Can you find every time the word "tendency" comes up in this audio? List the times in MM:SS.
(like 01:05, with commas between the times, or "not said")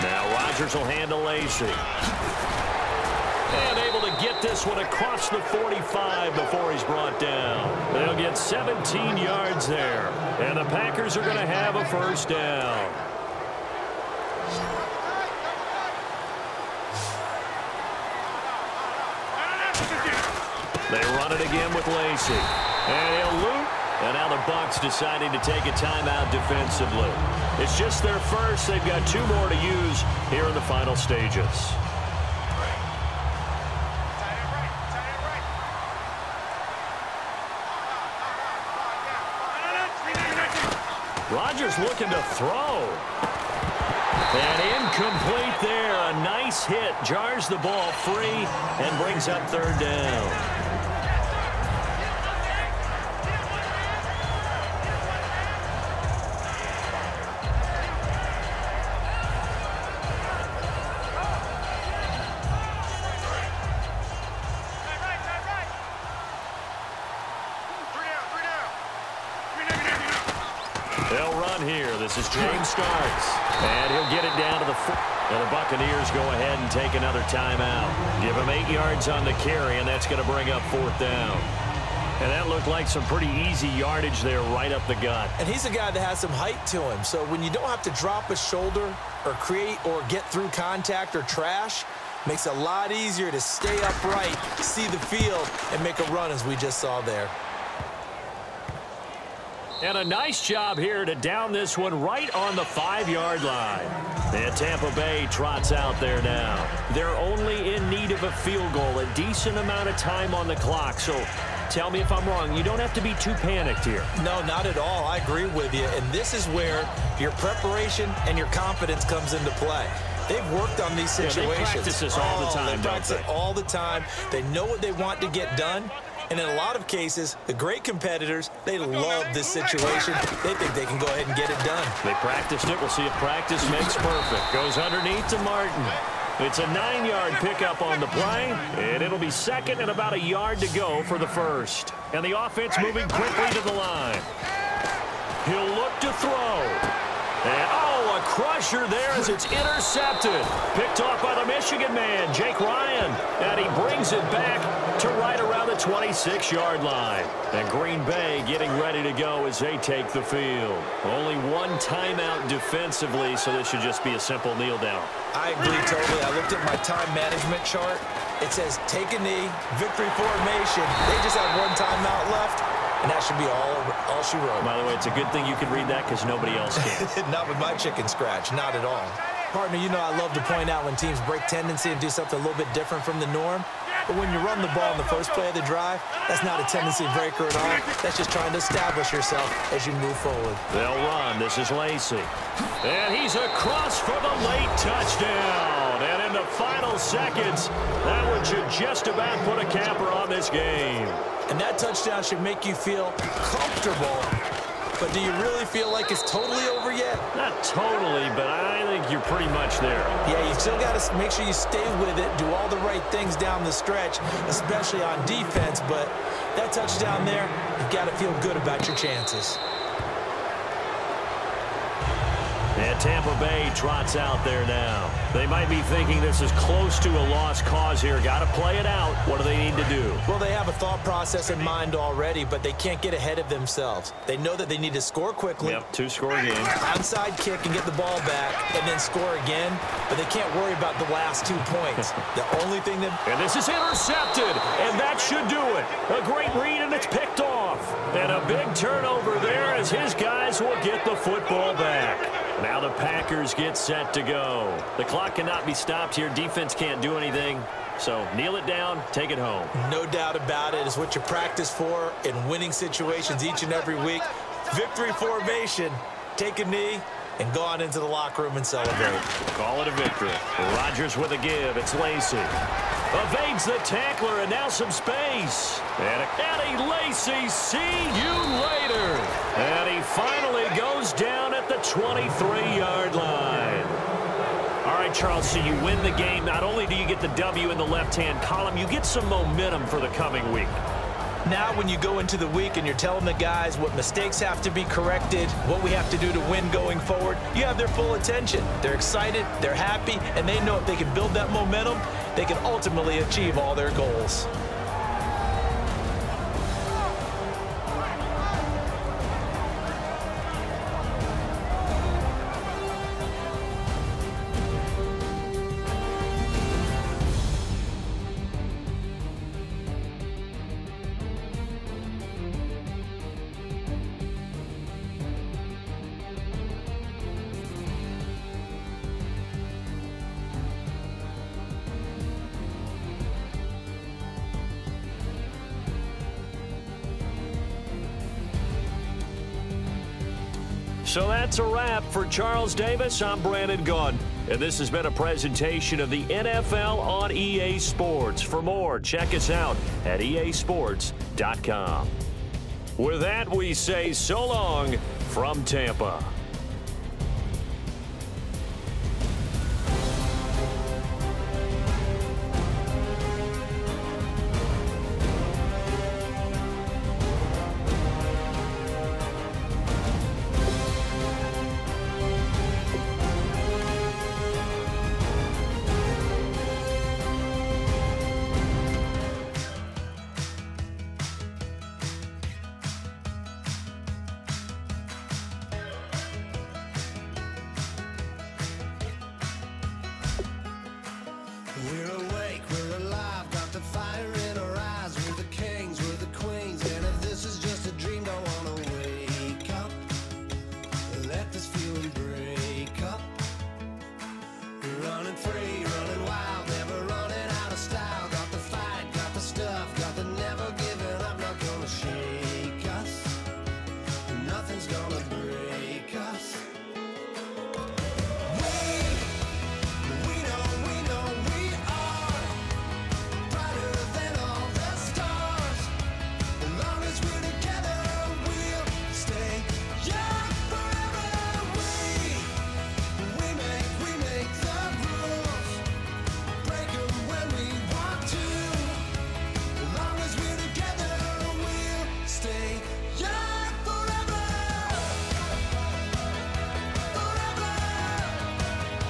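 03:01, 03:06.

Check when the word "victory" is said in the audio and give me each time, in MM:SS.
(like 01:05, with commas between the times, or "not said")
02:49, 04:24, 04:29.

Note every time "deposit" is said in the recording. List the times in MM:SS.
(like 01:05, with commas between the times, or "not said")
not said.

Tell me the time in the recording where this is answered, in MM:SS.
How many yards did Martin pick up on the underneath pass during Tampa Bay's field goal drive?
02:16.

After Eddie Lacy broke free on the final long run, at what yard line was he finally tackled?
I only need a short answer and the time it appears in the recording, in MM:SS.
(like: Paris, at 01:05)
23, at 04:41.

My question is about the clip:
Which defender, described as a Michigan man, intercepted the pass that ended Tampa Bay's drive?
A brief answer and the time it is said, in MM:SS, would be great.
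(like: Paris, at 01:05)
Jake Ryan, at 02:32.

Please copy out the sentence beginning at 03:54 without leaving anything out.
They know that they need to score quickly.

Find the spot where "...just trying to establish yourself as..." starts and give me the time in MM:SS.
03:08.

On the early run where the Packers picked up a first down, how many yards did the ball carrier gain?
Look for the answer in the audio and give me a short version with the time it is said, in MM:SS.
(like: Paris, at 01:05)
17, at 00:08.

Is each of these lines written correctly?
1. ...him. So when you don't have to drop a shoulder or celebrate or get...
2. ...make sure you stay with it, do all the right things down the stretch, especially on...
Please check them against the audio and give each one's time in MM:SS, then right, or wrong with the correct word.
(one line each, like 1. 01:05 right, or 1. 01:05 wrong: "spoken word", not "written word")
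1. 01:26 wrong: "create", not "celebrate"
2. 03:31 right.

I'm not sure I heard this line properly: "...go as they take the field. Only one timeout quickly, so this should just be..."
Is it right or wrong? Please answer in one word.
wrong.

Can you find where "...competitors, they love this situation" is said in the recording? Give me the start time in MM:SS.
02:07.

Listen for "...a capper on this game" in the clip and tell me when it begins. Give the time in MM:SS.
03:19.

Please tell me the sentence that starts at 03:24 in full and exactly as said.
But do you really feel like it's totally over yet?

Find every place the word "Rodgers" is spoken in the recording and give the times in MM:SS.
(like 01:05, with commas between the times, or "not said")
00:00, 00:41, 04:30.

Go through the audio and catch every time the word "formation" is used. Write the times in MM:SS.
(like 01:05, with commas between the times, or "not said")
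02:50, 04:25.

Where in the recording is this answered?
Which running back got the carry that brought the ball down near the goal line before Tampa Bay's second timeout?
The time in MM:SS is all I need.
01:12.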